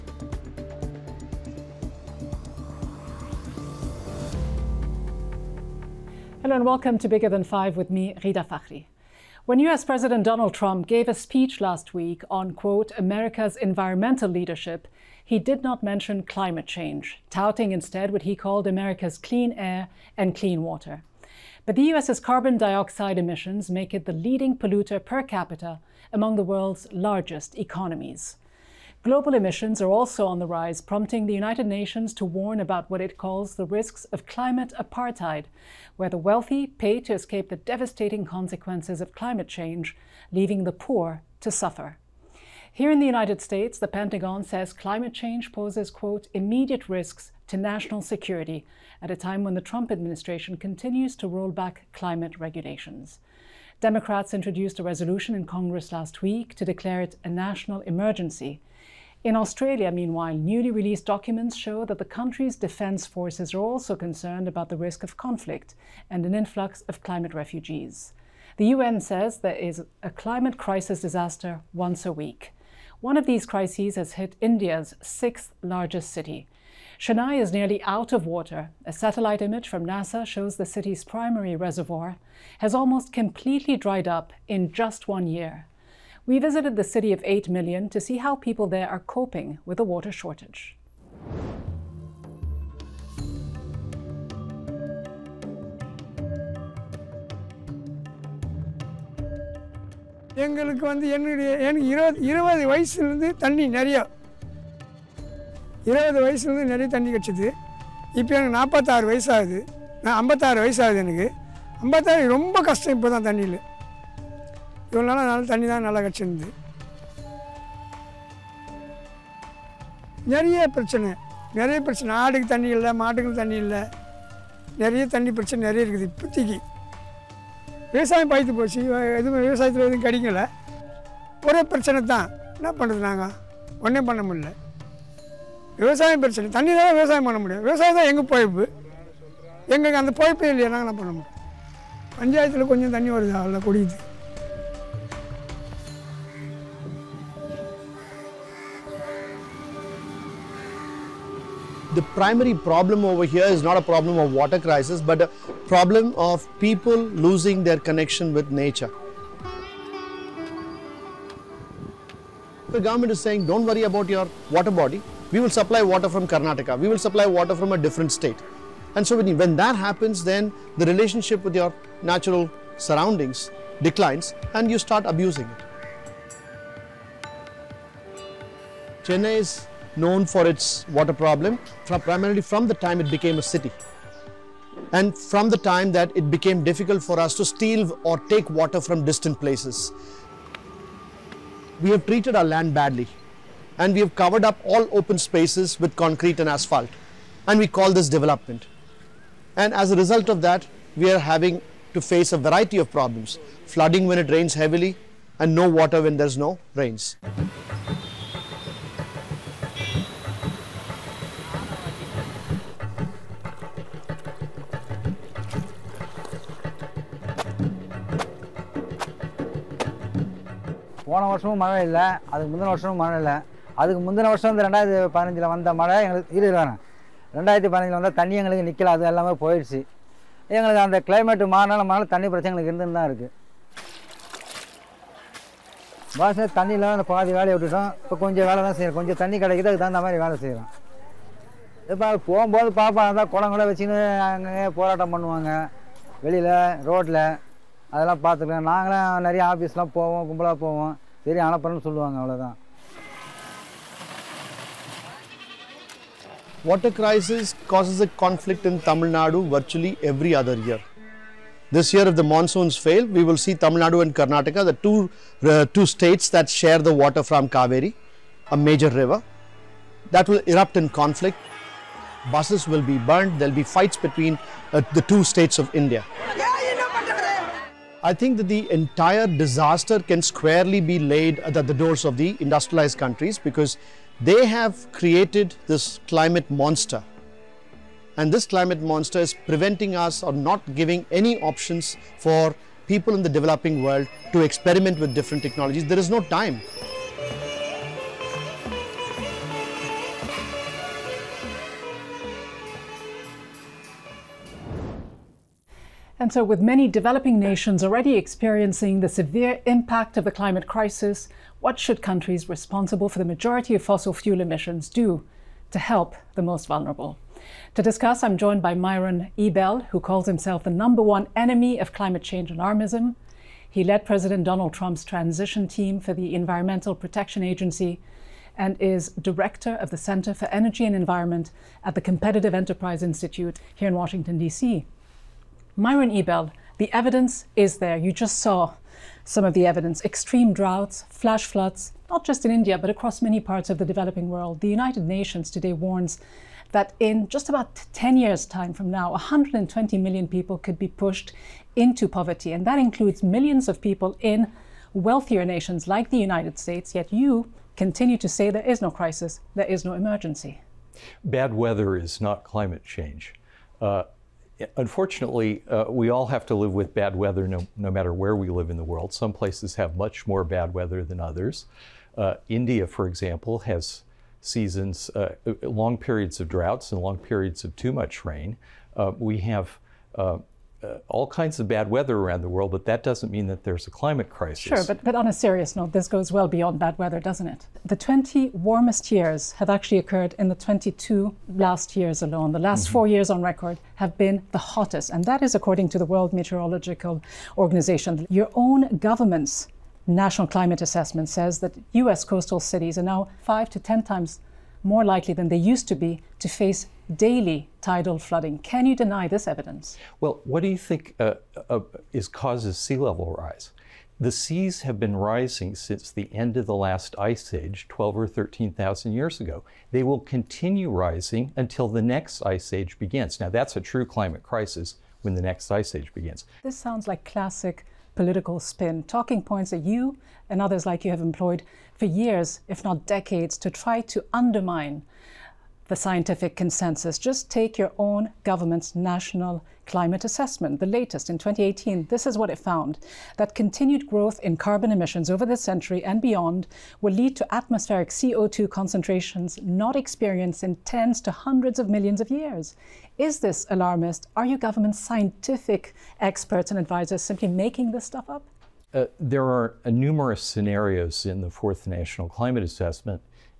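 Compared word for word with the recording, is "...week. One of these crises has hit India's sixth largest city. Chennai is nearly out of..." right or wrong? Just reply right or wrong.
right.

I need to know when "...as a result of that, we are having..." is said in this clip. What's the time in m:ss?
3:19.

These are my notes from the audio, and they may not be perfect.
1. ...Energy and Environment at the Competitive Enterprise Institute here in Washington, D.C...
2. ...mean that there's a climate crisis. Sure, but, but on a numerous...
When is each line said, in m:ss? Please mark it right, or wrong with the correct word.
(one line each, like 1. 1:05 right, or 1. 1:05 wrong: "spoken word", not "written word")
1. 5:30 right
2. 6:23 wrong: "serious", not "numerous".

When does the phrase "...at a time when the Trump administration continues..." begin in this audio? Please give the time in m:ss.
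0:49.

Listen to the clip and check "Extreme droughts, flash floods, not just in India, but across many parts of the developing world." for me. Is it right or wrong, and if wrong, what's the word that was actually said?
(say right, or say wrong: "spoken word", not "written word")
right.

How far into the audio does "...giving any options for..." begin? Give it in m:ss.
4:50.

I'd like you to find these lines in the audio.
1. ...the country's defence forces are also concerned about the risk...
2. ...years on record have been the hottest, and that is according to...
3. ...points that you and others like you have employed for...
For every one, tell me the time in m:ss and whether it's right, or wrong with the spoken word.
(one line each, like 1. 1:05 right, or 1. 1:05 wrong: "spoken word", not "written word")
1. 1:01 right
2. 6:33 right
3. 7:09 right.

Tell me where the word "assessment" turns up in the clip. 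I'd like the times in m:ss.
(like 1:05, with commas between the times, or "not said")
6:40, 7:20, 7:42.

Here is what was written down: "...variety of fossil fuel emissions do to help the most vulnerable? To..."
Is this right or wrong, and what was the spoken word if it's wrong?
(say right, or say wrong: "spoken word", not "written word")
wrong: "majority", not "variety".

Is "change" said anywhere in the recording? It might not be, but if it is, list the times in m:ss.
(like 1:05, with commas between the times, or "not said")
0:16, 0:39, 0:45, 5:22, 6:02.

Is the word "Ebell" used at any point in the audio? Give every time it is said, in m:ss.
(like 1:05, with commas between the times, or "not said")
5:19, 5:36.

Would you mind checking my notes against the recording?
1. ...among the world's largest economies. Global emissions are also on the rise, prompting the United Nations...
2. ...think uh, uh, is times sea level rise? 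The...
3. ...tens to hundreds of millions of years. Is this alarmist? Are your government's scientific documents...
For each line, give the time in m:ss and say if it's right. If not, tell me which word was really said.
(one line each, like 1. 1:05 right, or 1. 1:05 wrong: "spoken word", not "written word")
1. 0:26 right
2. 6:50 wrong: "causes", not "times"
3. 7:30 wrong: "experts", not "documents".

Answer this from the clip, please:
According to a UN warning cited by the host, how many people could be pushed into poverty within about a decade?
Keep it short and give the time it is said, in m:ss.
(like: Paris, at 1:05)
120 million, at 5:49.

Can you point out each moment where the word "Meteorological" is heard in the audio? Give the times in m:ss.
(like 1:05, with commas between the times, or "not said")
6:36.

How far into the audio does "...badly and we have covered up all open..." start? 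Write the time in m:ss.
3:12.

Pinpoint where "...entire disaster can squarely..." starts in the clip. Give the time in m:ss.
4:38.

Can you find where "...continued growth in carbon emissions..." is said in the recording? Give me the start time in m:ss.
7:23.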